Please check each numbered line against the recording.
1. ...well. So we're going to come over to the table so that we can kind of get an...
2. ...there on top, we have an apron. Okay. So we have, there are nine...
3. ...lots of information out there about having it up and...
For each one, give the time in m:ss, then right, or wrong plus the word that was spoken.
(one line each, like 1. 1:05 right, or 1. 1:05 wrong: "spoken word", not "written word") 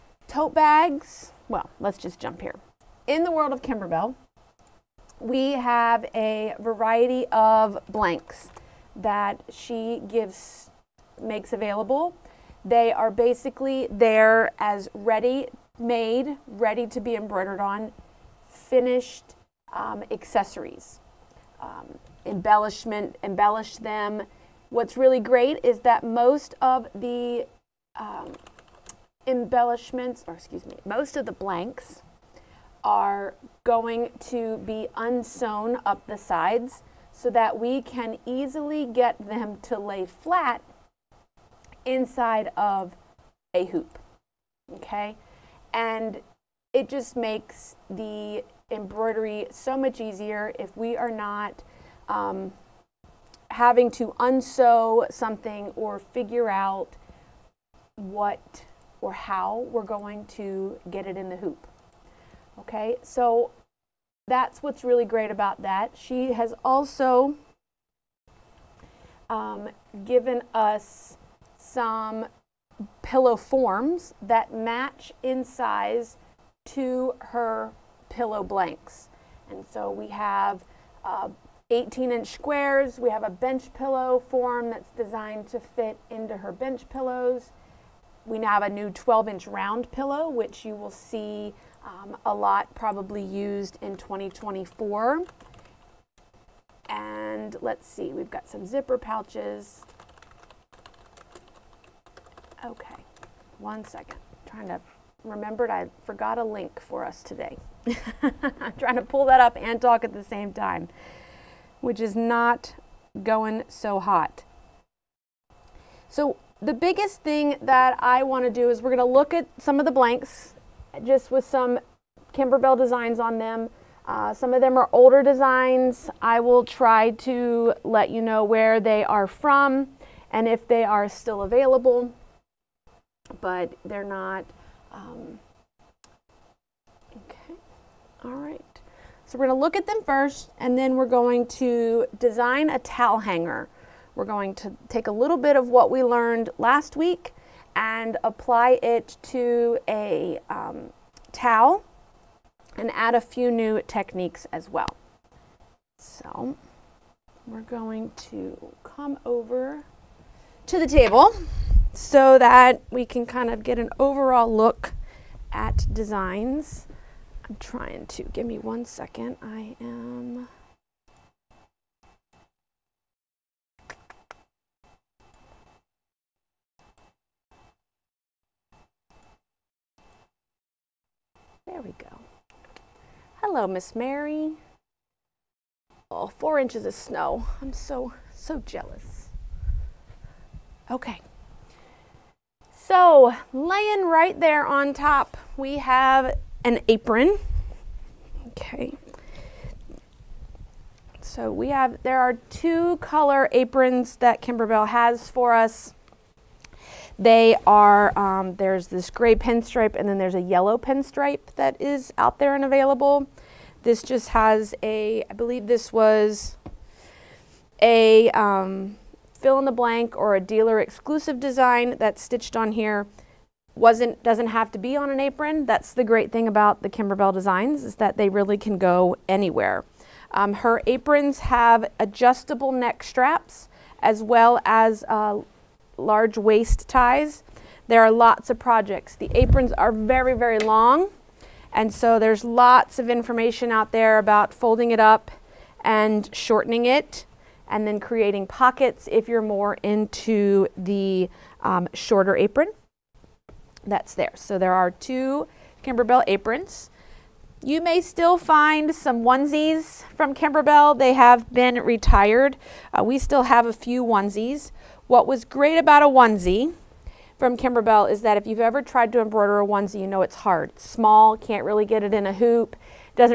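1. 2:34 right
2. 3:14 wrong: "two", not "nine"
3. 4:02 wrong: "folding", not "having".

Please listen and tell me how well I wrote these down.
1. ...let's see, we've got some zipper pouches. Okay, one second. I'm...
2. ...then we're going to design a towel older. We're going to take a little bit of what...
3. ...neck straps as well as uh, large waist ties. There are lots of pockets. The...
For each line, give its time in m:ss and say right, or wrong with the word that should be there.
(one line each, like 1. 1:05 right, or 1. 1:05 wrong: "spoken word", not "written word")
1. 1:37 right
2. 2:20 wrong: "hanger", not "older"
3. 3:52 wrong: "projects", not "pockets".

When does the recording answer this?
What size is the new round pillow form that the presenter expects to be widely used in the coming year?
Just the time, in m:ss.
1:28.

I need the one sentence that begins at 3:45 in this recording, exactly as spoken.
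That's the great thing about the Kimberbell designs is that they really can go anywhere.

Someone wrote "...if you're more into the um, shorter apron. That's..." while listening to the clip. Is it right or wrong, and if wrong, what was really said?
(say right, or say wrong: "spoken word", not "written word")
right.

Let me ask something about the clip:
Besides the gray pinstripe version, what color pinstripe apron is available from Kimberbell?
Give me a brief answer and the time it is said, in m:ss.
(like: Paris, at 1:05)
yellow, at 3:30.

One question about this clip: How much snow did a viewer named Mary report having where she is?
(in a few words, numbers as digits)
4 inches.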